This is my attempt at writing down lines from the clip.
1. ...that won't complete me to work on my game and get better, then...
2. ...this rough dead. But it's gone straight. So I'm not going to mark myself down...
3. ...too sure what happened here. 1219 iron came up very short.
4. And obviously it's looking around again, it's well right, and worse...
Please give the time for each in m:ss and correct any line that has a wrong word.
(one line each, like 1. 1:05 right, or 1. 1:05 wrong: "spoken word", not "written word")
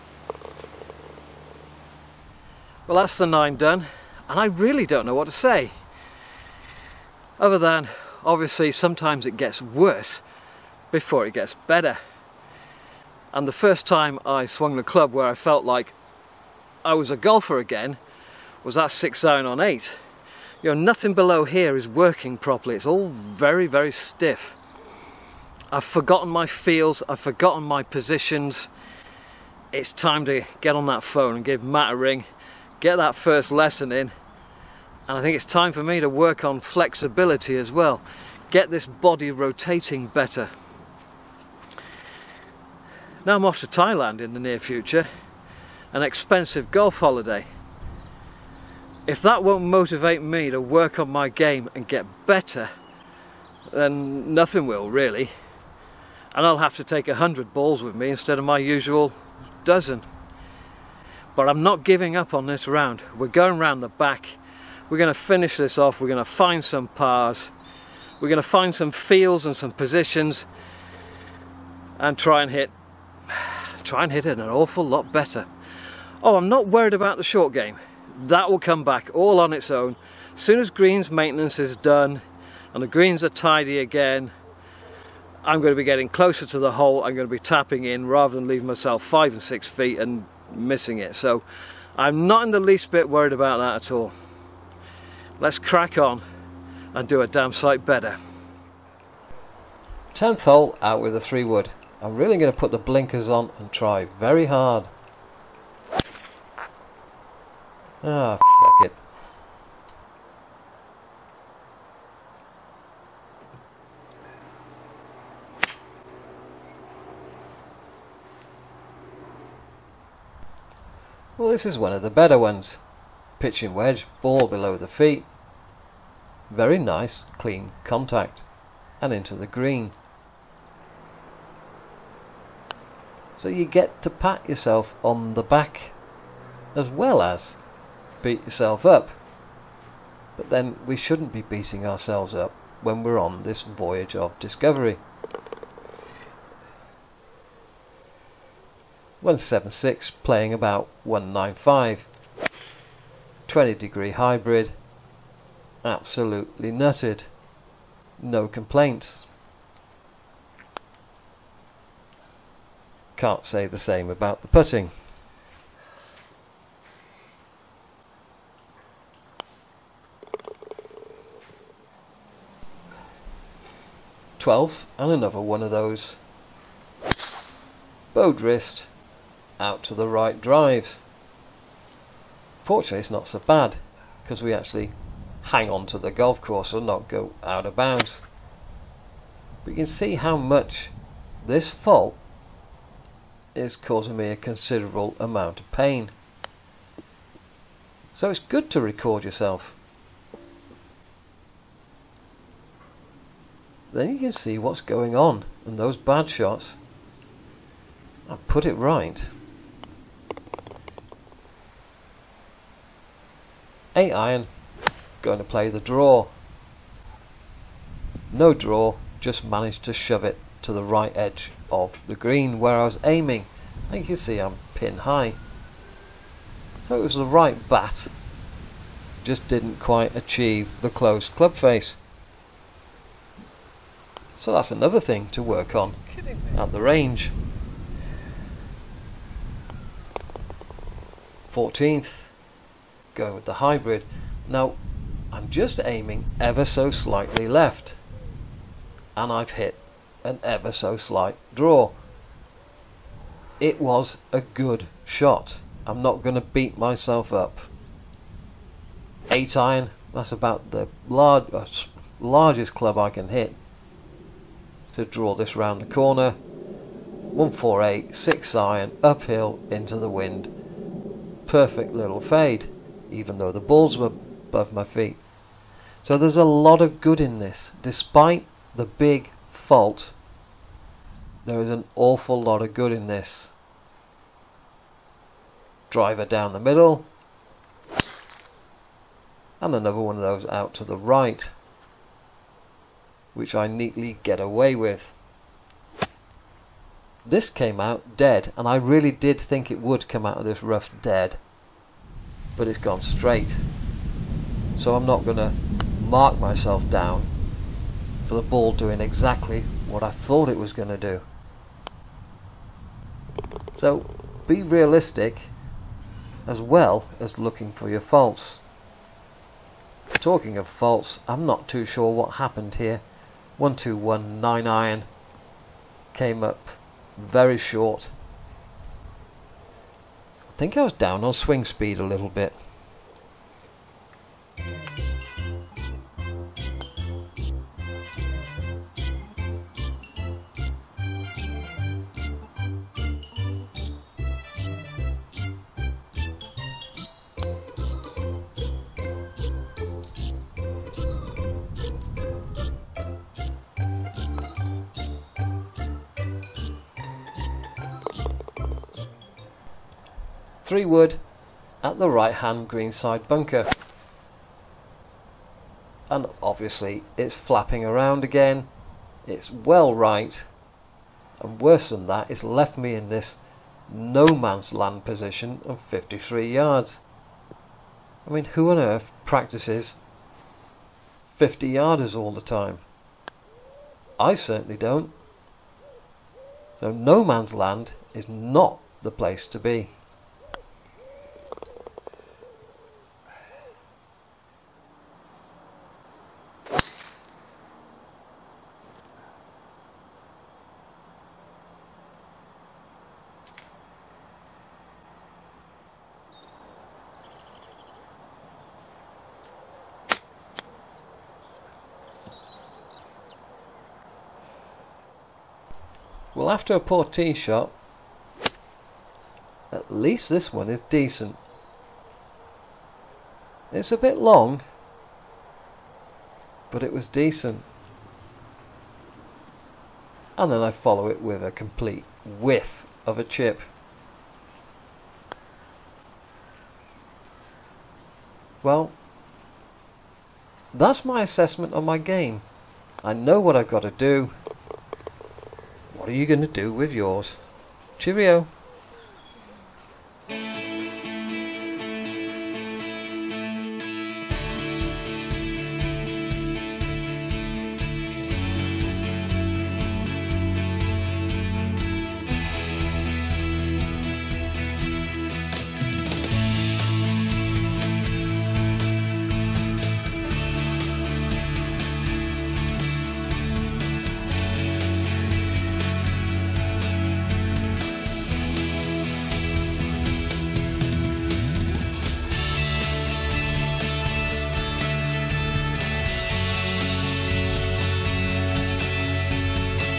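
1. 0:49 wrong: "motivate", not "complete"
2. 5:00 right
3. 5:21 right
4. 6:06 wrong: "flapping", not "looking".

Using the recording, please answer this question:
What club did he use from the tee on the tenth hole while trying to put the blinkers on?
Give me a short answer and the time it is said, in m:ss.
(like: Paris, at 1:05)
3 wood, at 1:41.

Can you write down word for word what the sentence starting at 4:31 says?
Perfect little fade, even though the balls were above my feet.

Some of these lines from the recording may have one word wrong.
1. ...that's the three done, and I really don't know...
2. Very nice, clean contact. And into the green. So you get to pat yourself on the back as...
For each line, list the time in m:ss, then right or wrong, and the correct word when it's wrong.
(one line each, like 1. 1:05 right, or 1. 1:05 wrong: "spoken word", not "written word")
1. 0:02 wrong: "nine", not "three"
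2. 2:06 right.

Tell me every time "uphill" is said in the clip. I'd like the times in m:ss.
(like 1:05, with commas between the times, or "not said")
4:29.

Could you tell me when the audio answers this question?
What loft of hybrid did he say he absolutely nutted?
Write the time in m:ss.
2:33.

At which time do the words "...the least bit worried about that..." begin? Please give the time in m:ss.
1:32.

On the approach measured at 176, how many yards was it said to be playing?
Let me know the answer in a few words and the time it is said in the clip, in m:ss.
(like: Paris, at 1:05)
195, at 2:30.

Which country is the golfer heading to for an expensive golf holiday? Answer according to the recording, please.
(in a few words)
Thailand.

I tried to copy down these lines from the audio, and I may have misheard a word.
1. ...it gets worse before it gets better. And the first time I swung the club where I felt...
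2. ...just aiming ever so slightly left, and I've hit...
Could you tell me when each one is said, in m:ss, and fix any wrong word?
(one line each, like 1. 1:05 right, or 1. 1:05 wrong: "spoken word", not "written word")
1. 0:09 right
2. 4:05 right.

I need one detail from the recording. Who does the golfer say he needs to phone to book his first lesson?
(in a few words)
Matt.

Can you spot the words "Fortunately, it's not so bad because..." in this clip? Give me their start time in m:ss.
3:02.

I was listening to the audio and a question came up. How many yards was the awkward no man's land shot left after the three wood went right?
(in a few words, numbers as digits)
53.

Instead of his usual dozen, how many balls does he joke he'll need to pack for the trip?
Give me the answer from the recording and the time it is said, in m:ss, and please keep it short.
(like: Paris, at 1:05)
100, at 0:57.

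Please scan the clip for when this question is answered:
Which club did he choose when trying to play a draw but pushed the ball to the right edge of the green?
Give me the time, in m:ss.
3:33.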